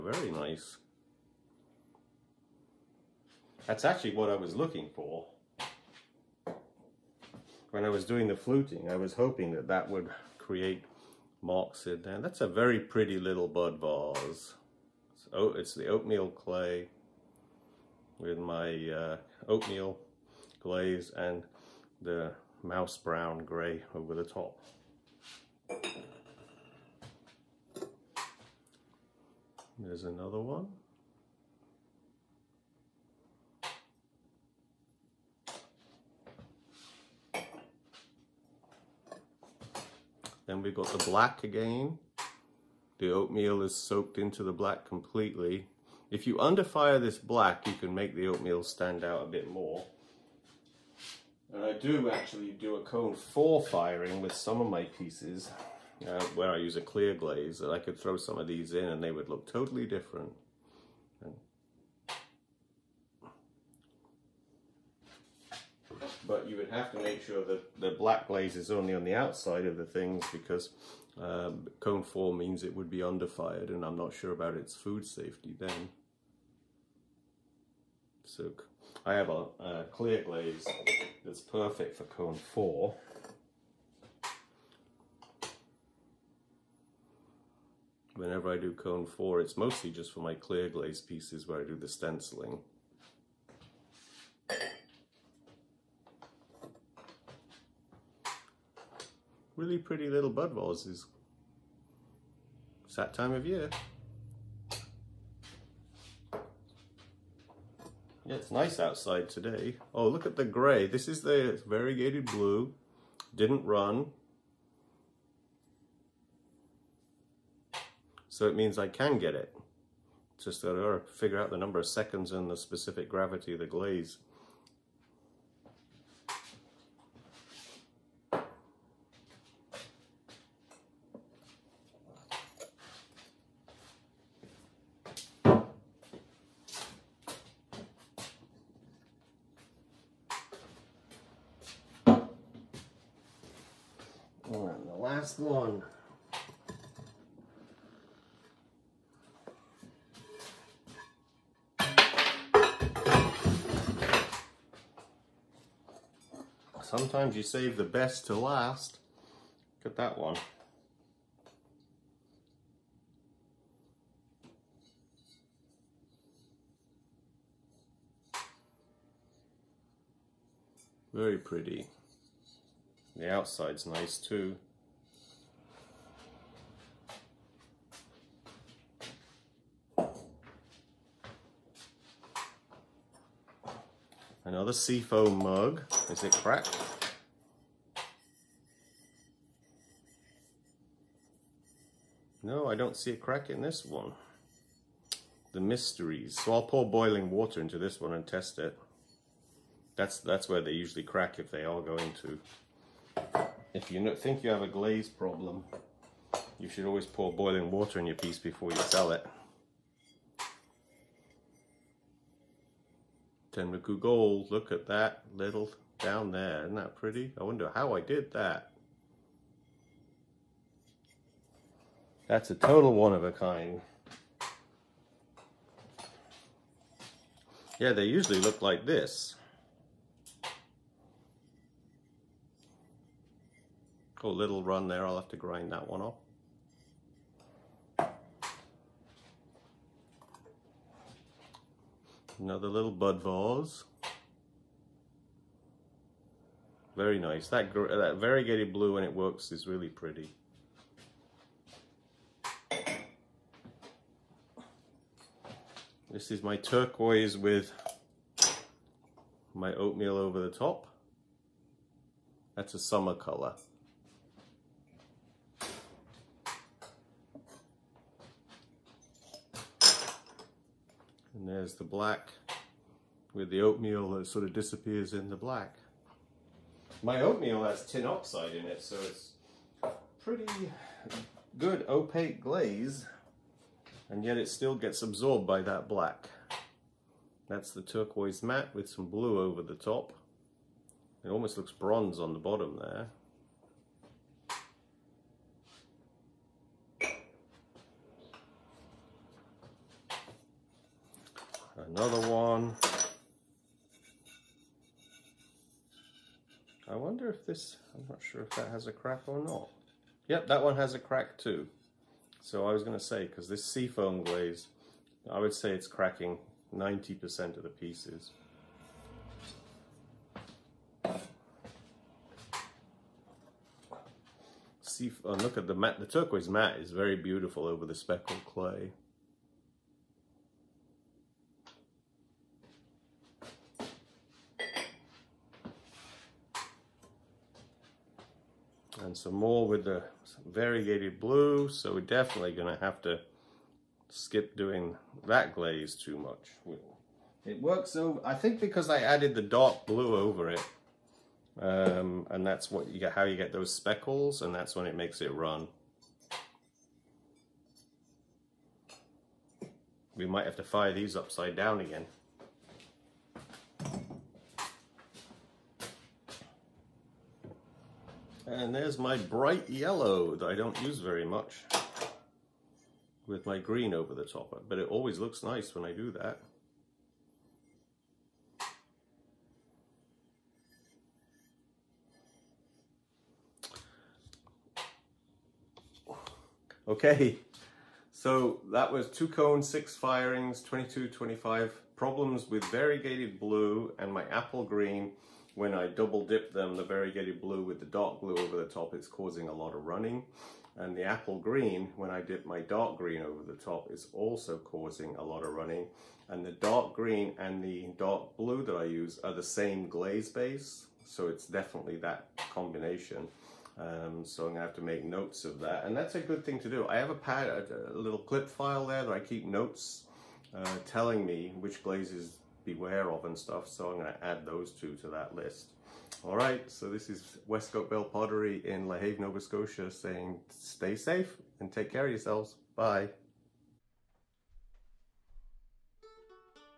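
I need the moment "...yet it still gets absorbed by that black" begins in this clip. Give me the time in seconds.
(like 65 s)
284 s.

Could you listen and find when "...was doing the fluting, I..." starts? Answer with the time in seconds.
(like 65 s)
7 s.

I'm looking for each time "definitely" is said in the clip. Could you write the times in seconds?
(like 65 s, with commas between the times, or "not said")
342 s, 411 s.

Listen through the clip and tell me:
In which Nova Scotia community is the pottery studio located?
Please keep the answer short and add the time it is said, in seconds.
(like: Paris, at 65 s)
LaHave, at 428 s.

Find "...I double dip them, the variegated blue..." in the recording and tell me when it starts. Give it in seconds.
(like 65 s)
395 s.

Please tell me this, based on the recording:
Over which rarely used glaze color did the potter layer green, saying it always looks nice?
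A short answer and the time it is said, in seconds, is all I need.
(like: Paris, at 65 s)
bright yellow, at 369 s.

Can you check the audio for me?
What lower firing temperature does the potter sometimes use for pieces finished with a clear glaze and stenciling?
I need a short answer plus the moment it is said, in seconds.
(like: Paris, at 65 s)
cone 4, at 52 s.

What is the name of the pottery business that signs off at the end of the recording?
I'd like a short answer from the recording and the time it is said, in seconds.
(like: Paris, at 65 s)
Westcote Bell Pottery, at 427 s.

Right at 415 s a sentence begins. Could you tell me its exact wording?
And that's a good thing to do.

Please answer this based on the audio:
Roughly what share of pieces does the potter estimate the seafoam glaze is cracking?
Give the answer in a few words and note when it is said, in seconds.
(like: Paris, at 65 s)
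90%, at 316 s.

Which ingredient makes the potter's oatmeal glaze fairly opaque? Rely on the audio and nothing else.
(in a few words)
tin oxide.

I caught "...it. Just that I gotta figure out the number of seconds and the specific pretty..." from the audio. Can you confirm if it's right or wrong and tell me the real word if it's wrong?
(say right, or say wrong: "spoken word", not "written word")
wrong: "gravity", not "pretty".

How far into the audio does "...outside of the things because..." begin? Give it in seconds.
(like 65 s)
69 s.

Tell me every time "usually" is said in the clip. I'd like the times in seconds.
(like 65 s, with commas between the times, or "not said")
200 s, 228 s.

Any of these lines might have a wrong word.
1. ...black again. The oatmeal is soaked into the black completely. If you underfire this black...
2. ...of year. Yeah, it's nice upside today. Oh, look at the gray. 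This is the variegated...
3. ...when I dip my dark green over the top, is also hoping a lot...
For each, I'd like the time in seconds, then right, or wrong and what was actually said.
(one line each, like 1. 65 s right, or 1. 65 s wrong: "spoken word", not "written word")
1. 41 s right
2. 103 s wrong: "outside", not "upside"
3. 401 s wrong: "causing", not "hoping".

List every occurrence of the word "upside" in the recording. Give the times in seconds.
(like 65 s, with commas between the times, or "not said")
361 s.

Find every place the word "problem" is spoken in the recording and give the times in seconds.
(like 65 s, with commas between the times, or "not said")
205 s, 391 s.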